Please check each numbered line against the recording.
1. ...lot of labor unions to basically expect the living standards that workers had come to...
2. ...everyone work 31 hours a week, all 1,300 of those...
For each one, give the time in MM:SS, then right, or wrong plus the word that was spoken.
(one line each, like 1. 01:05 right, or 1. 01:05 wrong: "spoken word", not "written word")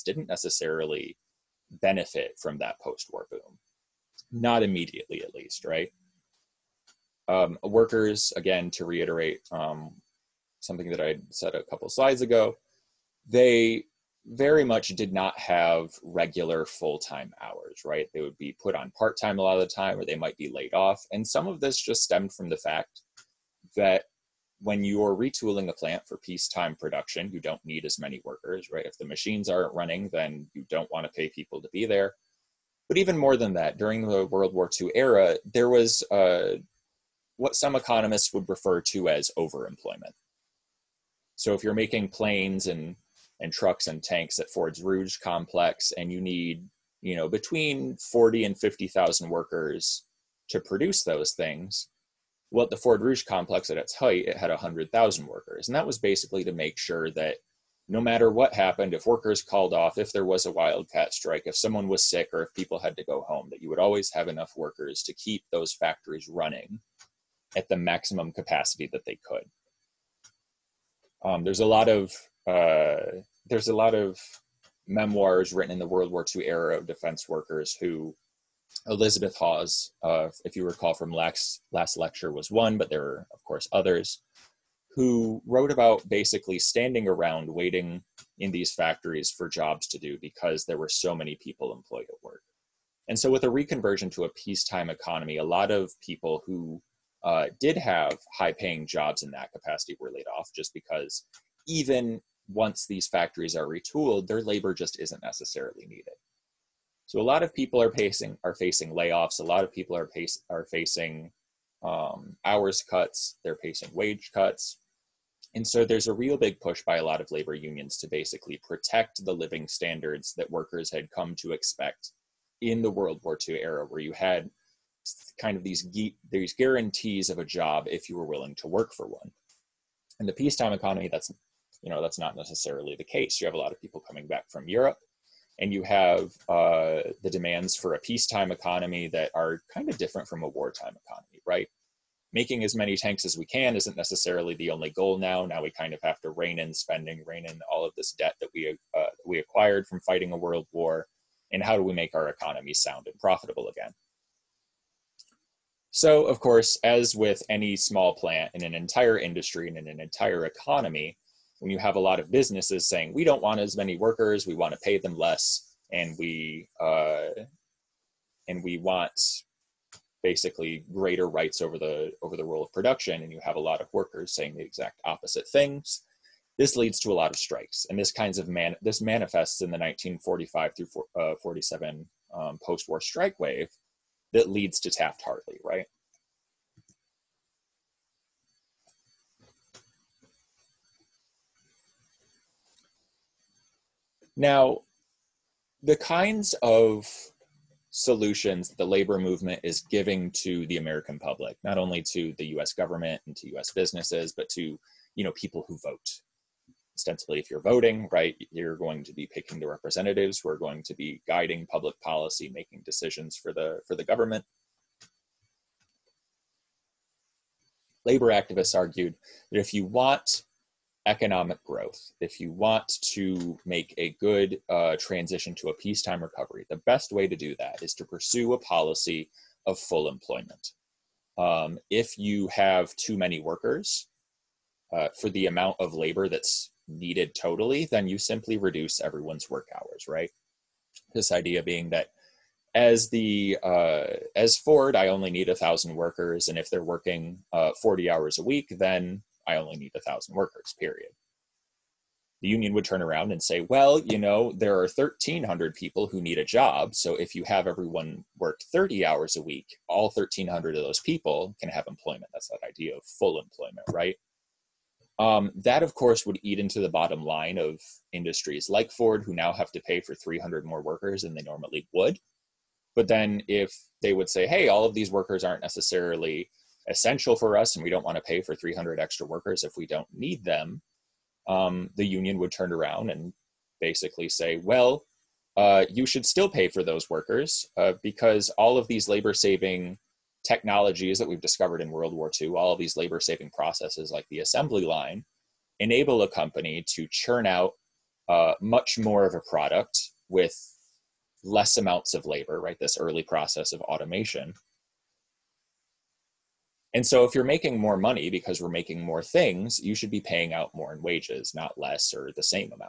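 1. 01:57 wrong: "protect", not "expect"
2. 04:17 wrong: "30", not "31".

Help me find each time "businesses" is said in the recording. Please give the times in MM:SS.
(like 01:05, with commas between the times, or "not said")
02:42, 03:23.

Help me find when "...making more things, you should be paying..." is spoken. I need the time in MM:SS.
05:08.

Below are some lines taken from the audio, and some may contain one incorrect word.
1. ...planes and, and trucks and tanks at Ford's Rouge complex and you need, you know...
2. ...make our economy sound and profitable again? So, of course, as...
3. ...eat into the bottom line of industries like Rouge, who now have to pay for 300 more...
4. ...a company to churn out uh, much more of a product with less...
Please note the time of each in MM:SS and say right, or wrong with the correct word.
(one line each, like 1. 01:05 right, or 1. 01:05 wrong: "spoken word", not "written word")
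1. 00:42 right
2. 02:31 right
3. 04:26 wrong: "Ford", not "Rouge"
4. 04:56 right.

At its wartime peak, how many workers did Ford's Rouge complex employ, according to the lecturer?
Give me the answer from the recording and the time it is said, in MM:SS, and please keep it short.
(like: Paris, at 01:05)
100,000, at 00:54.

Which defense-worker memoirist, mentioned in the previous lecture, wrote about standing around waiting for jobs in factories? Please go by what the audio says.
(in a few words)
Elizabeth Hawes.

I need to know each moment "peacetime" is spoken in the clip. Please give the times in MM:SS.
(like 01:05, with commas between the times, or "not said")
00:26, 01:34, 02:10, 02:17, 03:45.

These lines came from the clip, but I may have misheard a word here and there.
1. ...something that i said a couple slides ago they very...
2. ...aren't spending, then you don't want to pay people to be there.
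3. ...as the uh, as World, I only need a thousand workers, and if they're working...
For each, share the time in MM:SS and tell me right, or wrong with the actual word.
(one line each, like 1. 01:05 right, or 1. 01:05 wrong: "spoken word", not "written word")
1. 00:10 right
2. 00:29 wrong: "running", not "spending"
3. 04:02 wrong: "Ford", not "World".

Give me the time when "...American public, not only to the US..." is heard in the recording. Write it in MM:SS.
03:20.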